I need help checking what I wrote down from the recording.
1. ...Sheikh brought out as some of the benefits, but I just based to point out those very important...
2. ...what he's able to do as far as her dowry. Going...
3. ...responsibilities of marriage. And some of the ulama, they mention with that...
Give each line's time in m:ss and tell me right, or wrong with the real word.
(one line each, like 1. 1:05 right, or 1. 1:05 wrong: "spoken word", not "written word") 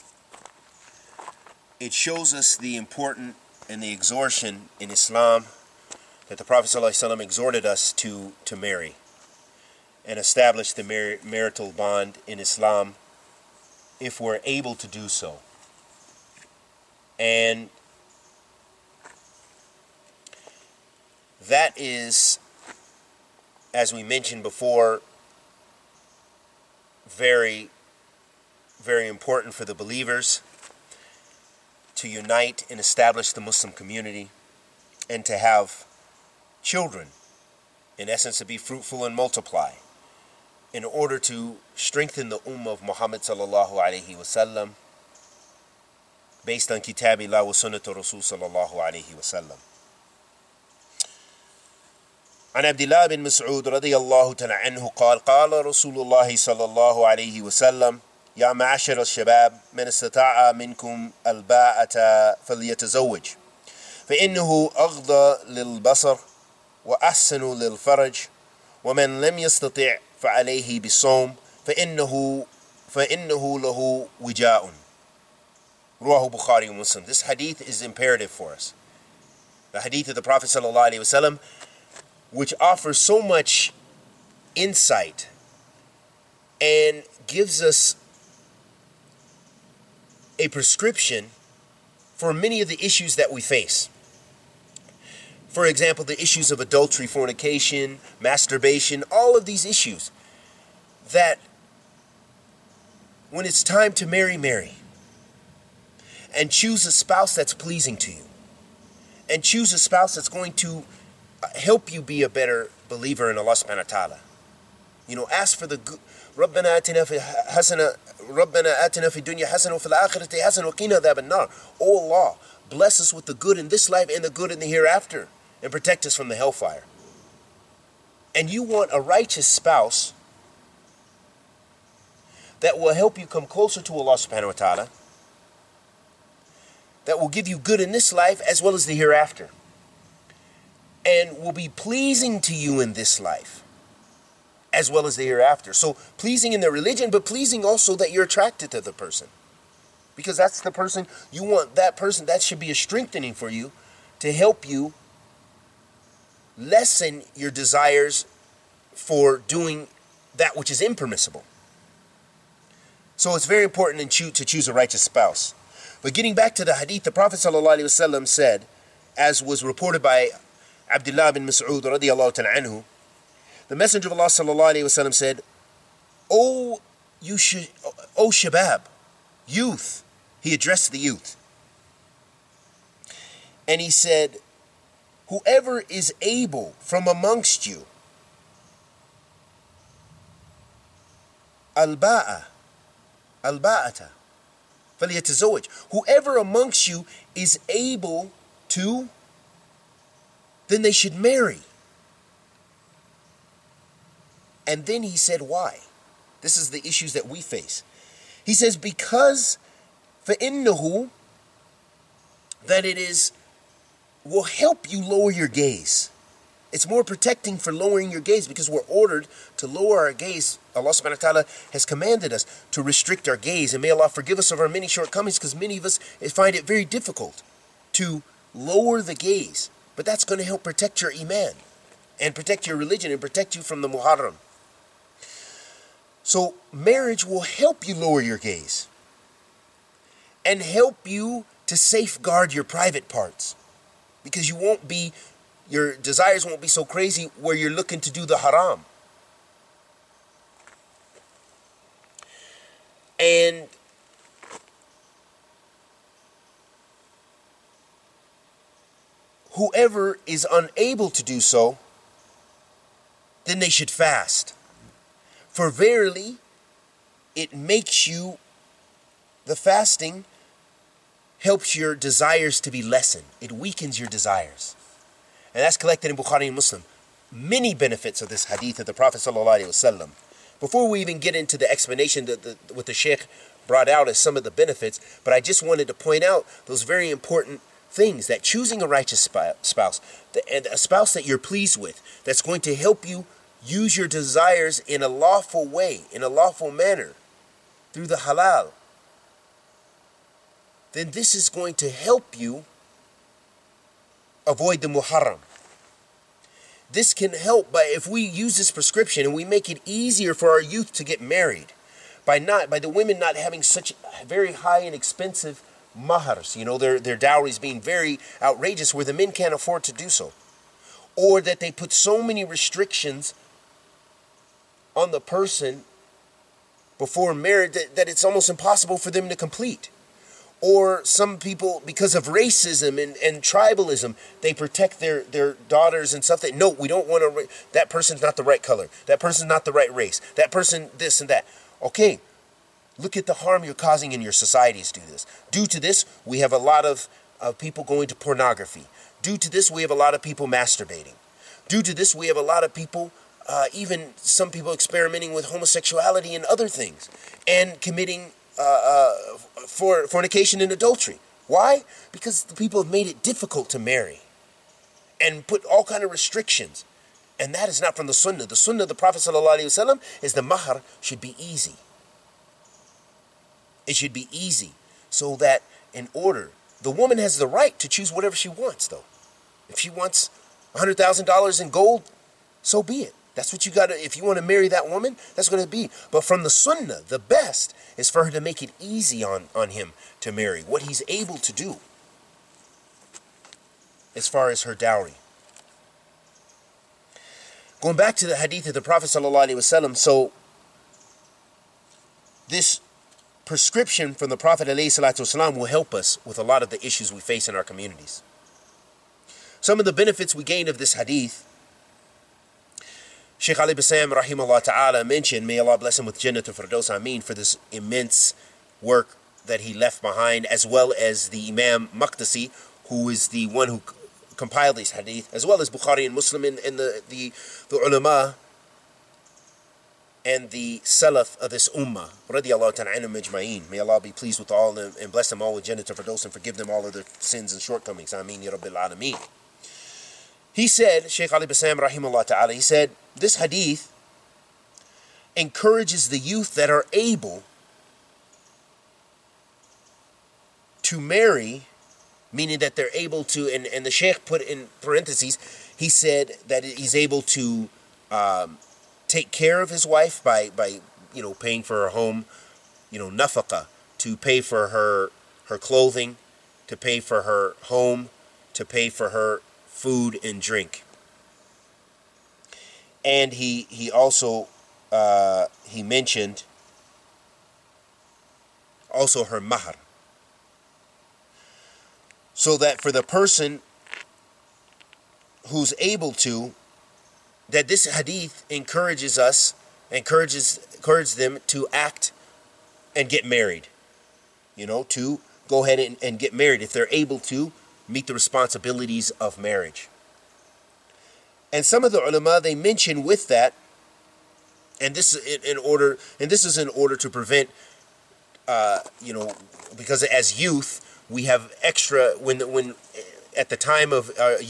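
1. 4:42 wrong: "wanted", not "based"
2. 6:30 right
3. 8:18 right.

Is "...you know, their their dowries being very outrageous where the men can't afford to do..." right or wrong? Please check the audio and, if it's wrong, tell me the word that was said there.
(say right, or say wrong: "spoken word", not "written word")
right.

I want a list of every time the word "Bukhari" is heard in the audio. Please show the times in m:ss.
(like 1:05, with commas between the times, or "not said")
1:16, 4:36, 7:05.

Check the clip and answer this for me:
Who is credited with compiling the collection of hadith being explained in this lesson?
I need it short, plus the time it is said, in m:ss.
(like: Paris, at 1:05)
Imam Maqdisi, at 7:01.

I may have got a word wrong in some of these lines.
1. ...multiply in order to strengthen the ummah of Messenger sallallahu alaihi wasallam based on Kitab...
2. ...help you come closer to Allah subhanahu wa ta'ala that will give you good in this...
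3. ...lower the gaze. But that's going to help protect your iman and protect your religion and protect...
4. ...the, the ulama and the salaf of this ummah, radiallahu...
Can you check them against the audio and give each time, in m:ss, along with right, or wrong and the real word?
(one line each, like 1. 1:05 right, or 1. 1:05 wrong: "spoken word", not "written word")
1. 0:39 wrong: "Muhammad", not "Messenger"
2. 2:12 right
3. 3:48 right
4. 7:07 right.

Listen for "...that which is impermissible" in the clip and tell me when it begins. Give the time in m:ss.
2:40.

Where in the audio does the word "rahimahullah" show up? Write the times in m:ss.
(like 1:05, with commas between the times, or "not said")
6:54, 7:21.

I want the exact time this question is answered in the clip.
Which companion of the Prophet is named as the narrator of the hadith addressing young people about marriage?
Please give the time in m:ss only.
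2:50.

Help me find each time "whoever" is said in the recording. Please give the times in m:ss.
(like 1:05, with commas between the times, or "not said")
3:05, 3:15, 4:19.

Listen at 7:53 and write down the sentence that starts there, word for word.
And he he also uh, he mentioned also her mahar.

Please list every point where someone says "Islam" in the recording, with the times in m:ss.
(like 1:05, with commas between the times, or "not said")
0:04, 0:12.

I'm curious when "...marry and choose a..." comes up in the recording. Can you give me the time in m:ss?
1:44.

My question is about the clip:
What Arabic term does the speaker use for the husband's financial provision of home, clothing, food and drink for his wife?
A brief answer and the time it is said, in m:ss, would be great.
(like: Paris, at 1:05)
Nafaka, at 7:43.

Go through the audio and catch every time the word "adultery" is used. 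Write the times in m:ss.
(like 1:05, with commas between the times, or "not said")
1:36, 6:00.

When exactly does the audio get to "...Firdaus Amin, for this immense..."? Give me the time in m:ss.
6:56.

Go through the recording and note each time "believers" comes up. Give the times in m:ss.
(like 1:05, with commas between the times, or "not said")
0:29, 1:52.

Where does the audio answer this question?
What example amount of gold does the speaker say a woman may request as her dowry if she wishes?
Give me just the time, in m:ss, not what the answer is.
6:20.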